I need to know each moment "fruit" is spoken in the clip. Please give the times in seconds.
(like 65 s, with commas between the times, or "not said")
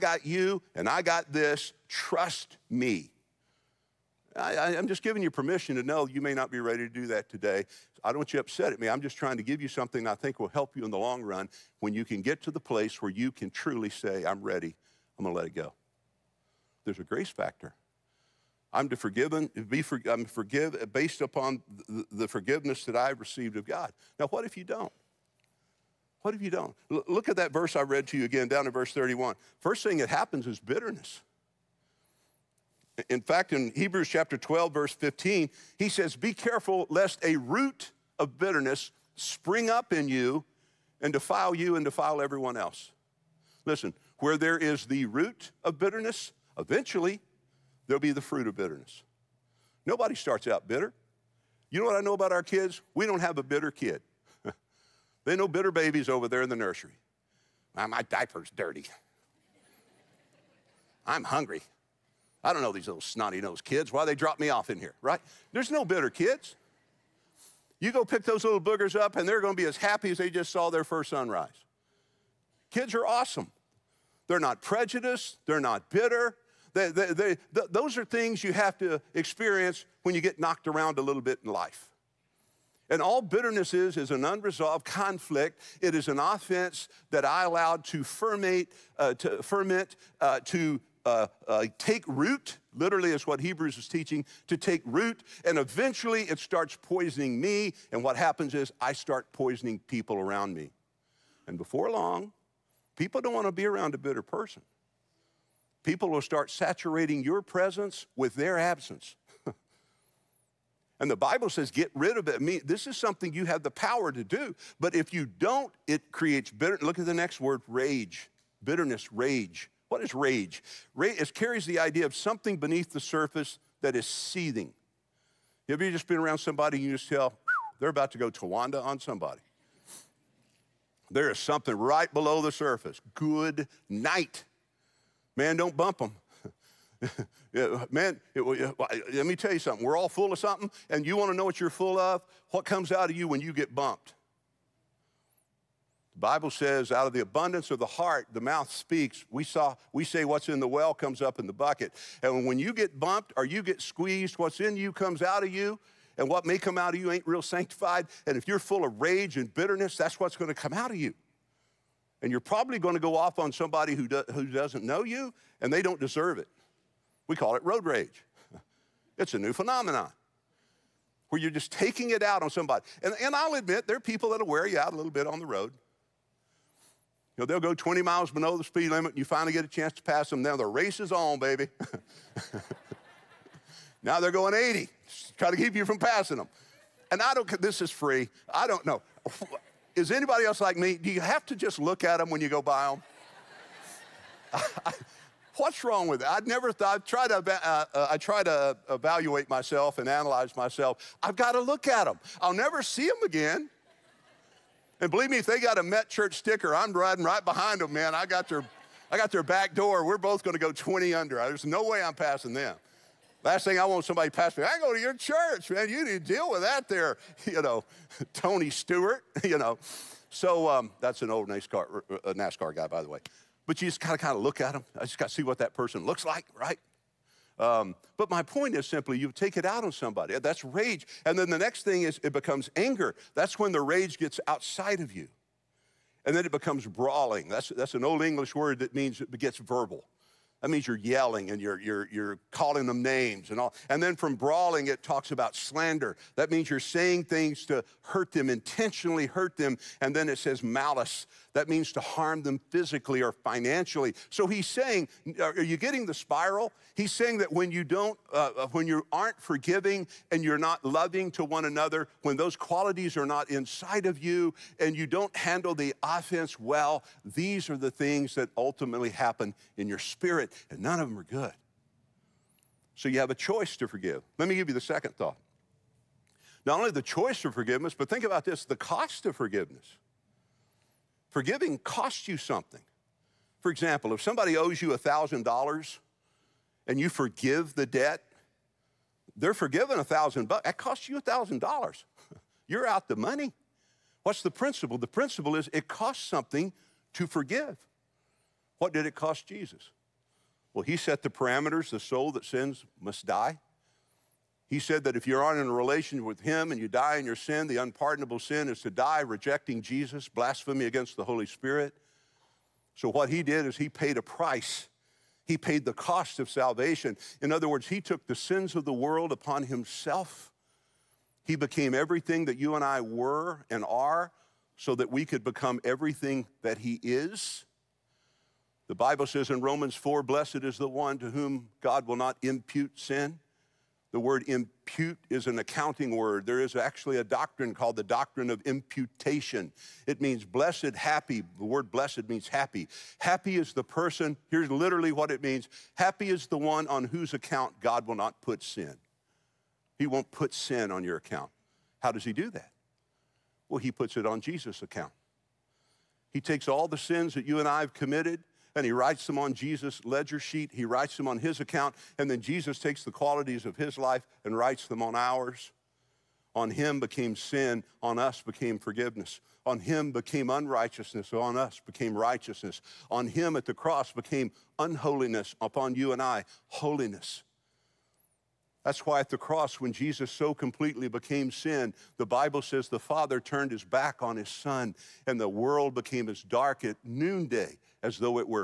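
48 s.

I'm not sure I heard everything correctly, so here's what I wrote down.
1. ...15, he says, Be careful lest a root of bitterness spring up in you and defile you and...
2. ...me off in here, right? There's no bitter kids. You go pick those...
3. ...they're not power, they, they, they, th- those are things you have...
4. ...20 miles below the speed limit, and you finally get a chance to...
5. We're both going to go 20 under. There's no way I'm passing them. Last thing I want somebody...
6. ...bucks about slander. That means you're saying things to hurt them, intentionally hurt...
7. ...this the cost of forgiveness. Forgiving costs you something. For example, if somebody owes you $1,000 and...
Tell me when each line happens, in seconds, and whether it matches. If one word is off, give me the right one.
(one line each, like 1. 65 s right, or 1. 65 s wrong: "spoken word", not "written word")
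1. 34 s right
2. 64 s right
3. 75 s wrong: "bitter", not "power"
4. 177 s right
5. 210 s right
6. 245 s wrong: "talks", not "bucks"
7. 278 s right.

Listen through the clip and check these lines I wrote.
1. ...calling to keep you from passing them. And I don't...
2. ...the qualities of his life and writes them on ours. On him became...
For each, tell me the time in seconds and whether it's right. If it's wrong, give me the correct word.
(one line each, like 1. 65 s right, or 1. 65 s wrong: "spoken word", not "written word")
1. 185 s wrong: "trying", not "calling"
2. 363 s right.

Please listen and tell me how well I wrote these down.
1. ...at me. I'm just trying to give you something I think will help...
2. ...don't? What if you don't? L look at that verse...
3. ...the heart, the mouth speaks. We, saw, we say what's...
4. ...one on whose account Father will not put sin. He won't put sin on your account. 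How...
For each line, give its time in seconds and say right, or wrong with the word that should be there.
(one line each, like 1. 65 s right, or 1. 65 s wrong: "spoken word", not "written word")
1. 8 s right
2. 24 s right
3. 147 s right
4. 346 s wrong: "God", not "Father".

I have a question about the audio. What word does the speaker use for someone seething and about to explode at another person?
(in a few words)
Towanda.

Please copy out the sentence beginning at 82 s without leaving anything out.
And all bitterness is, is an unresolved conflict.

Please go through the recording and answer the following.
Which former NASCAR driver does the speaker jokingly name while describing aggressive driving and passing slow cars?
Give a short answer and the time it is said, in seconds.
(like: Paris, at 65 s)
Tony Stewart, at 218 s.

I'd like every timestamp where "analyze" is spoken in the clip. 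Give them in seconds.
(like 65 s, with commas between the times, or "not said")
200 s.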